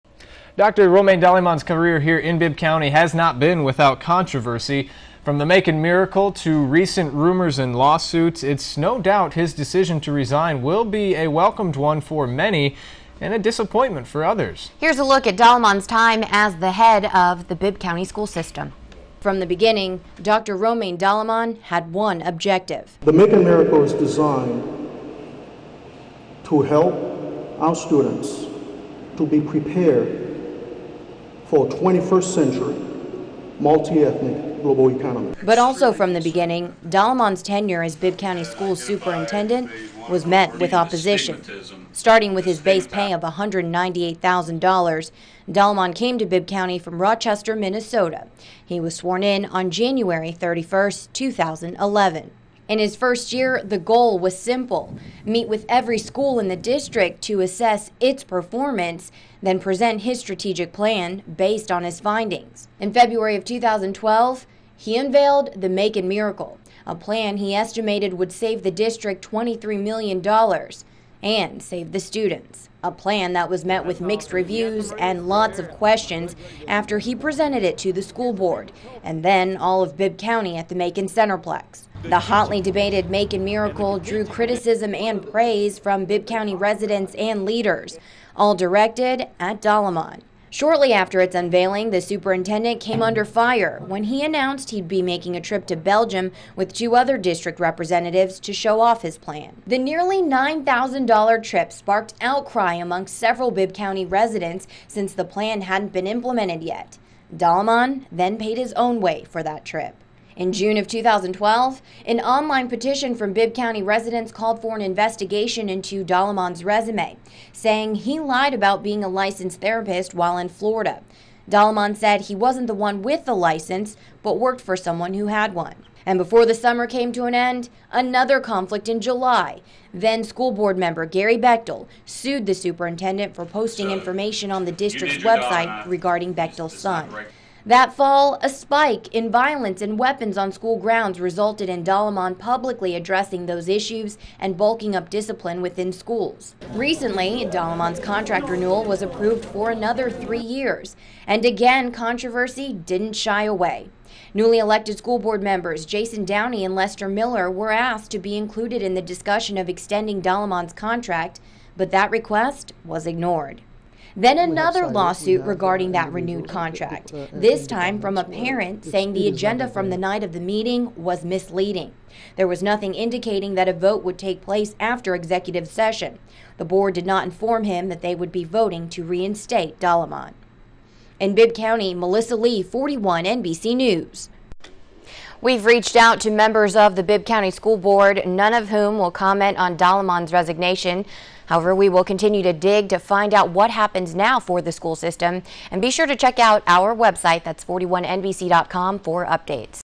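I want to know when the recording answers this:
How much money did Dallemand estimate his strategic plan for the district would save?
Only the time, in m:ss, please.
1:09.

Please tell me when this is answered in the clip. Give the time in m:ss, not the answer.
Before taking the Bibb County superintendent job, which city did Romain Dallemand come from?
0:47.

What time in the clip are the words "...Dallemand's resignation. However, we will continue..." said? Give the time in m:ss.
3:09.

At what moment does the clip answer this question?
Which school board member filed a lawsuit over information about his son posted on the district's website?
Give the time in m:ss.
2:11.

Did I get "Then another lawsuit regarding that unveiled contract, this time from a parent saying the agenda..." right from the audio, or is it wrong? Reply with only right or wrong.
wrong.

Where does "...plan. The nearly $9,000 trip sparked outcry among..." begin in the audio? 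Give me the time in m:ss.
1:39.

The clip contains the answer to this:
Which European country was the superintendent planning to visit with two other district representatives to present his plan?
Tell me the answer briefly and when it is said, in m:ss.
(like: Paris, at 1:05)
Belgium, at 1:35.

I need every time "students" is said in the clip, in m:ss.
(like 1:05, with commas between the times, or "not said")
0:27, 1:11.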